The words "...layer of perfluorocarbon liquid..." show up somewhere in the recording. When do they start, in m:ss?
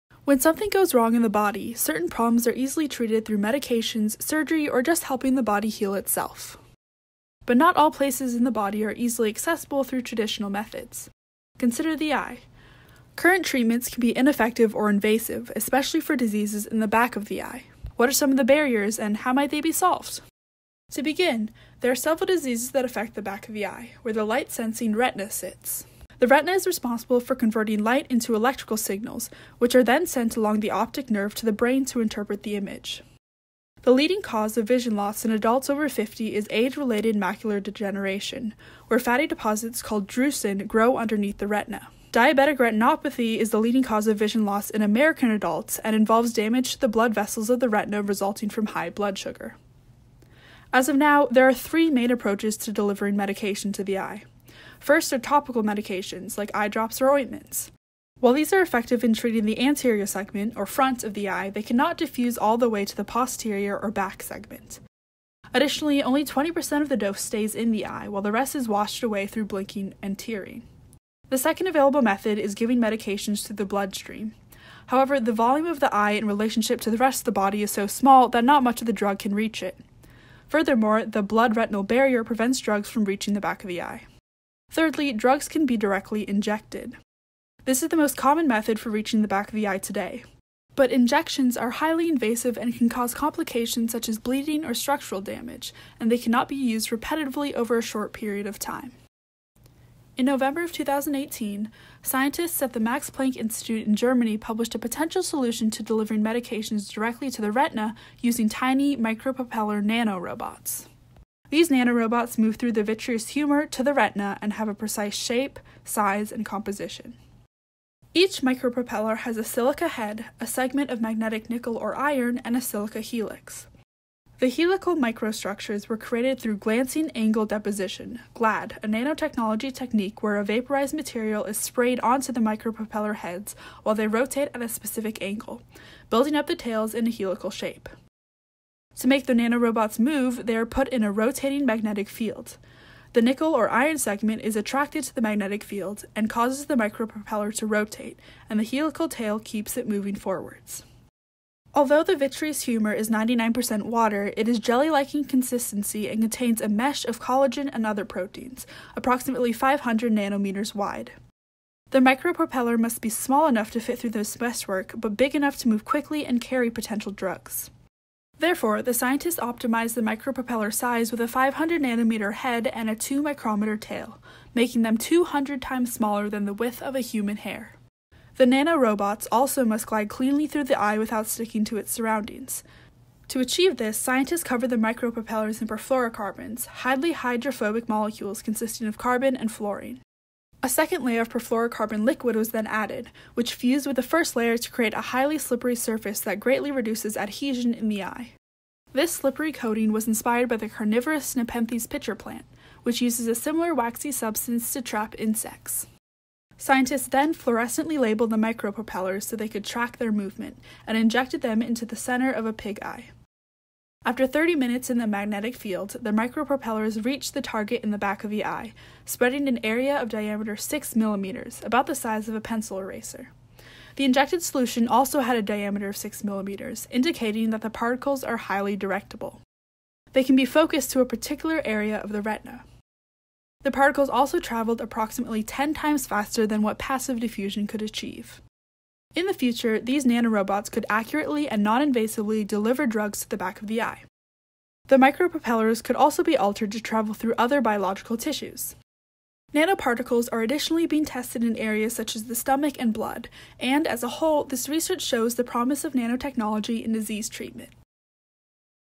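3:11.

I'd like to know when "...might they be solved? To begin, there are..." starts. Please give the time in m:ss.
0:19.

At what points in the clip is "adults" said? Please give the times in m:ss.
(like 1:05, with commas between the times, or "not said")
0:35, 0:45.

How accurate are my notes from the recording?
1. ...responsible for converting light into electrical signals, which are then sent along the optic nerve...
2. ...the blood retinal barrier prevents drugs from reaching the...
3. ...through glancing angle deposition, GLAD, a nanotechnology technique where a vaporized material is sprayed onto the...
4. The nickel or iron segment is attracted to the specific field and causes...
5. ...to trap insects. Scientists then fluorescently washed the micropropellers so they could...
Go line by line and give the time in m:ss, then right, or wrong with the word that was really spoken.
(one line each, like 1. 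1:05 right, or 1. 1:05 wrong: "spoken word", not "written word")
1. 0:26 right
2. 1:21 right
3. 2:06 right
4. 2:23 wrong: "magnetic", not "specific"
5. 3:24 wrong: "labeled", not "washed".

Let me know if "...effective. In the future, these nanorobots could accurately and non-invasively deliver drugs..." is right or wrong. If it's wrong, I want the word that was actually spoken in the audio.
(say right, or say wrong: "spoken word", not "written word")
wrong: "achieve", not "effective".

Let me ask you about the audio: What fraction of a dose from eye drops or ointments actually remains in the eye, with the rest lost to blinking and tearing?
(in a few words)
20%.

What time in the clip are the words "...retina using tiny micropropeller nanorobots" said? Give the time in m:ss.
1:47.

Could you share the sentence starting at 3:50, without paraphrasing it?
They can be focused to a particular area of the retina.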